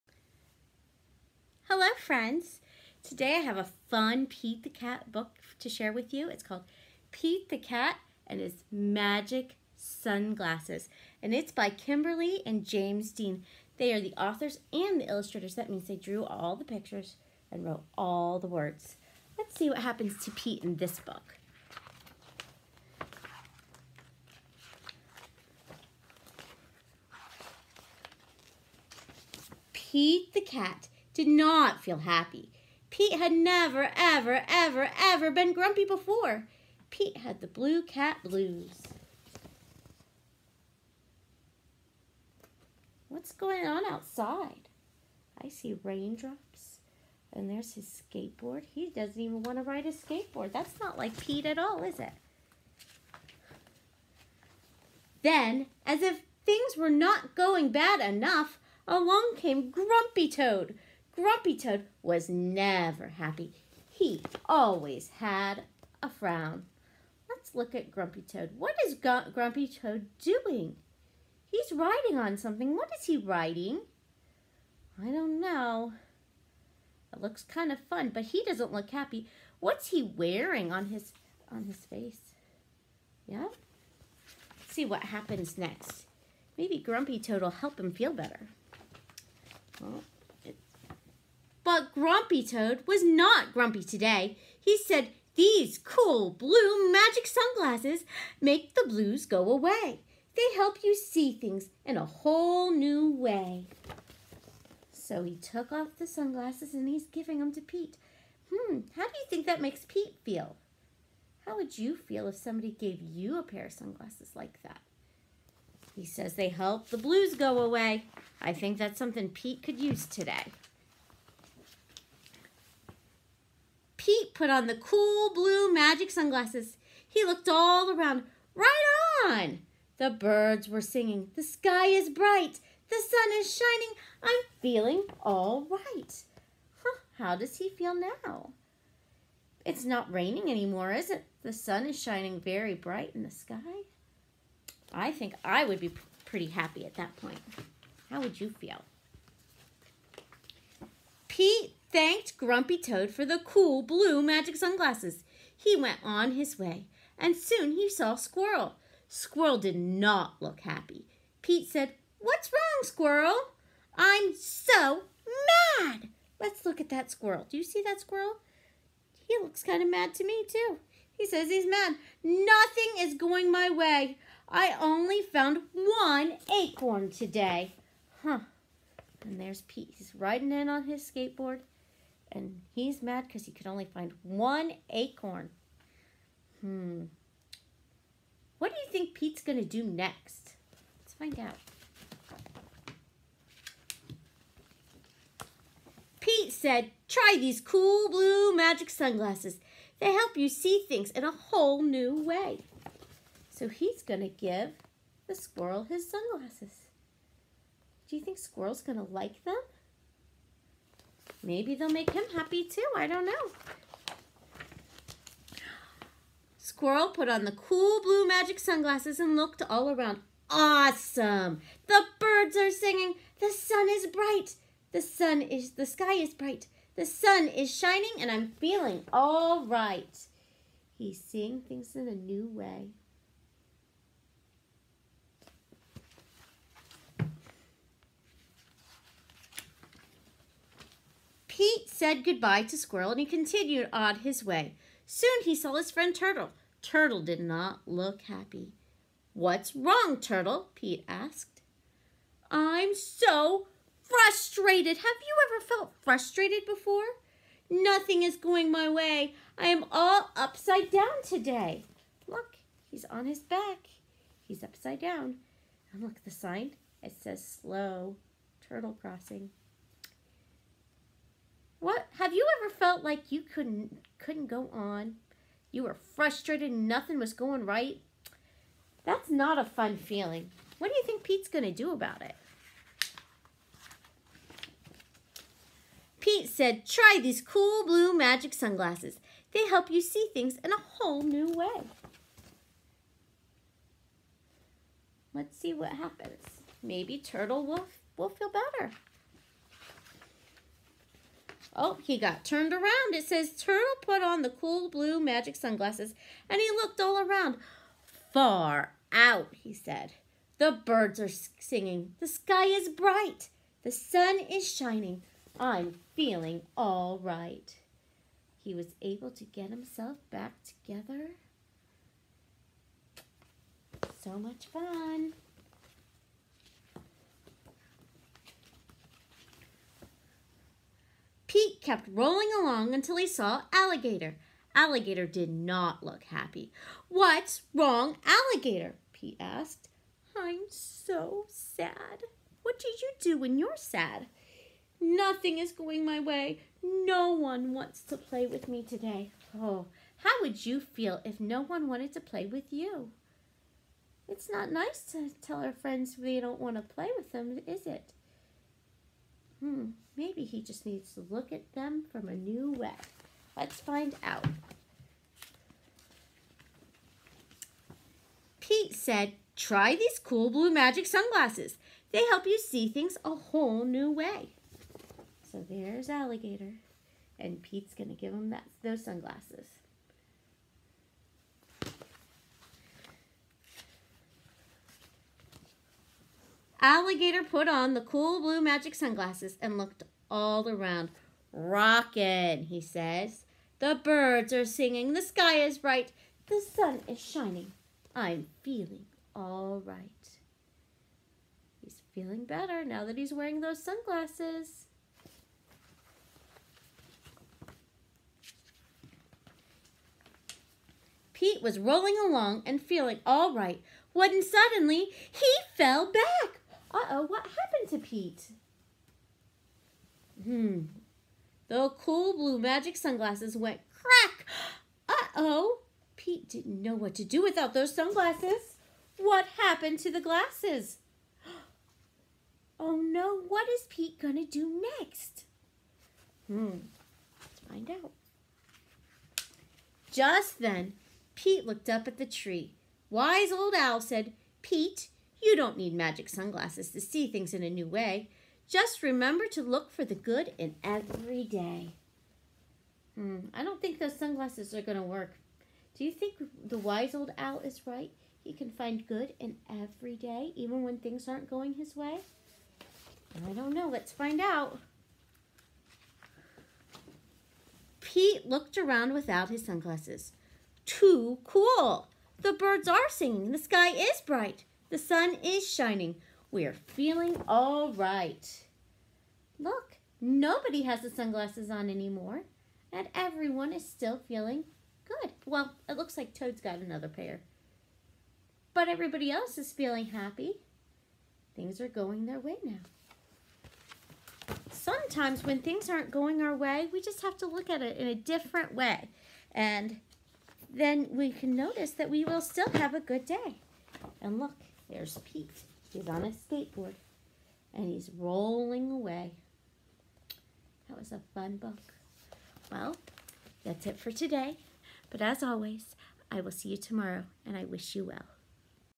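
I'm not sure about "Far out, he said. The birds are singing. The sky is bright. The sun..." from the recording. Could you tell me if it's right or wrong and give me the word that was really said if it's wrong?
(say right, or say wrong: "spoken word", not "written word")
right.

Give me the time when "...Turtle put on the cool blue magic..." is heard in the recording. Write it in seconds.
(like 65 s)
303 s.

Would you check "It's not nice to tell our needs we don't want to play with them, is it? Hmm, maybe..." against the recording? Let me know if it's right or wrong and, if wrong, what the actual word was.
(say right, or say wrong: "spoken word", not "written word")
wrong: "friends", not "needs".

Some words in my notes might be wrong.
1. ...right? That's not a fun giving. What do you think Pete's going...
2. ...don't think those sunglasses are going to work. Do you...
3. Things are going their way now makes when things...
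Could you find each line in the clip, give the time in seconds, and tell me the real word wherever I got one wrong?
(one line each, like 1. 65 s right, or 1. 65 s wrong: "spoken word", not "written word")
1. 277 s wrong: "feeling", not "giving"
2. 453 s right
3. 491 s wrong: "sometimes", not "makes".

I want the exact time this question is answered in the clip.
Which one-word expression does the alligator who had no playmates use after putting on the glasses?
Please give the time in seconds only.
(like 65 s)
391 s.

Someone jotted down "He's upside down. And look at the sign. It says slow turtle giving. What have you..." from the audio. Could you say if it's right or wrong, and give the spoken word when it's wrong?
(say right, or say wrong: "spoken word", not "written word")
wrong: "crossing", not "giving".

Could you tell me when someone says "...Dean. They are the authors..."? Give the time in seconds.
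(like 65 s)
13 s.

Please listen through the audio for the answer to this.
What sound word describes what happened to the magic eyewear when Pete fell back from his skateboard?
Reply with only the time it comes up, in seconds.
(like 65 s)
423 s.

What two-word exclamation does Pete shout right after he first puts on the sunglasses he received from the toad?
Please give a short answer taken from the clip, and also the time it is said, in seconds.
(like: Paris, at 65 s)
Right on, at 128 s.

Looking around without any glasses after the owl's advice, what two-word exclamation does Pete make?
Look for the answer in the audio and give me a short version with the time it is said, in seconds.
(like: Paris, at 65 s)
Too cool, at 470 s.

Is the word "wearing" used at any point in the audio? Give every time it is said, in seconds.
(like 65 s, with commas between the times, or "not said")
80 s, 403 s.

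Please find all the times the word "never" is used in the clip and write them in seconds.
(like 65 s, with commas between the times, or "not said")
33 s, 62 s.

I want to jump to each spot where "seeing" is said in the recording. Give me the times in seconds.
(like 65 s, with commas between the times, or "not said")
231 s.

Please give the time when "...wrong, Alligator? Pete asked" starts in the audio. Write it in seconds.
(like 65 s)
337 s.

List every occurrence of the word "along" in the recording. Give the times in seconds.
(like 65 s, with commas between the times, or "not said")
58 s, 332 s, 412 s.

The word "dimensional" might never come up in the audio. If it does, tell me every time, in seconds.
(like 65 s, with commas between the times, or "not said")
not said.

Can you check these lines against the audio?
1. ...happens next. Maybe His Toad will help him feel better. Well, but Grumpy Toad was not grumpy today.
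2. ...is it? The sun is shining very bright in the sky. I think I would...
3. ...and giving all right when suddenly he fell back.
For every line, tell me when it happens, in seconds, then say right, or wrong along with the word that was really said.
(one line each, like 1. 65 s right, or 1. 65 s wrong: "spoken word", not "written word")
1. 85 s wrong: "Grumpy", not "His"
2. 140 s right
3. 412 s wrong: "feeling", not "giving".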